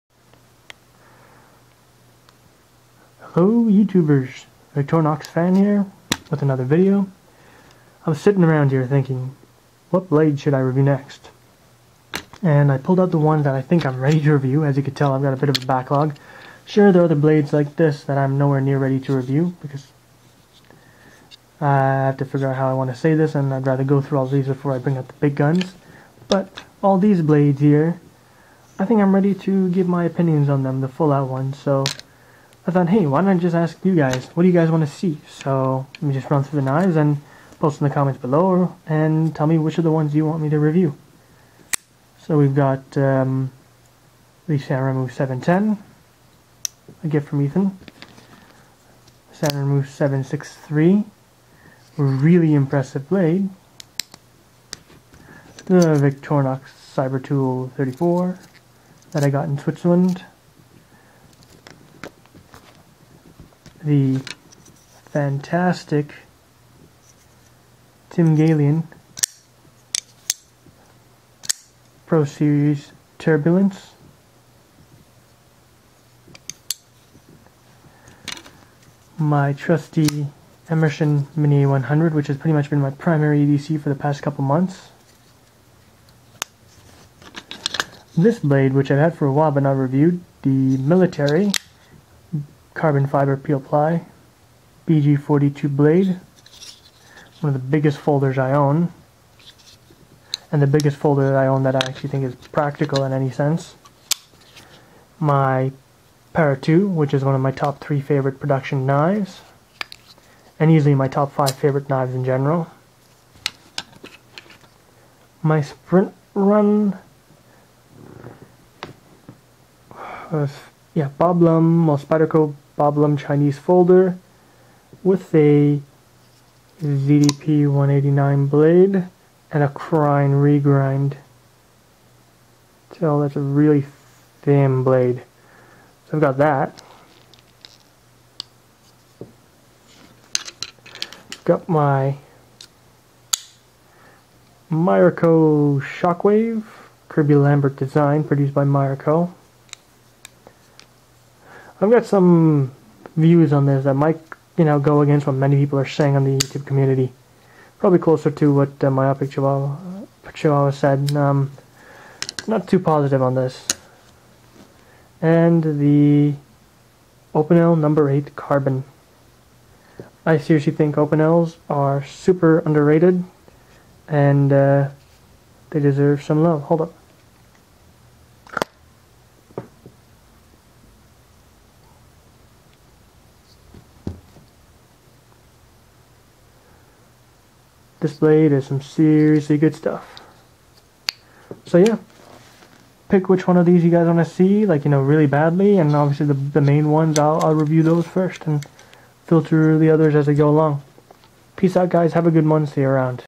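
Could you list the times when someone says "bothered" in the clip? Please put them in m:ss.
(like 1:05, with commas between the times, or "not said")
not said.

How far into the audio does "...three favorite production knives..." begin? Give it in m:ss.
1:47.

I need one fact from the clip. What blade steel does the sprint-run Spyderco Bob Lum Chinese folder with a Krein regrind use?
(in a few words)
ZDP 189.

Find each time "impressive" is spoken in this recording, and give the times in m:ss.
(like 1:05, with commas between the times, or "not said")
0:52.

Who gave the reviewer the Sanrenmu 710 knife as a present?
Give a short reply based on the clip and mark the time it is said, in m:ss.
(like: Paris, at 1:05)
Ethan, at 0:47.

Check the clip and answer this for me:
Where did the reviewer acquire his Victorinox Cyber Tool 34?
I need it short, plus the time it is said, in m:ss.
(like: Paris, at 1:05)
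Switzerland, at 0:59.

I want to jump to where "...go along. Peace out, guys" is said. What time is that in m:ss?
3:20.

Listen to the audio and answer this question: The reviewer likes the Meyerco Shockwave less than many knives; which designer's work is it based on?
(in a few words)
Kirby Lambert.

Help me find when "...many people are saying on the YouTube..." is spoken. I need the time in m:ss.
2:35.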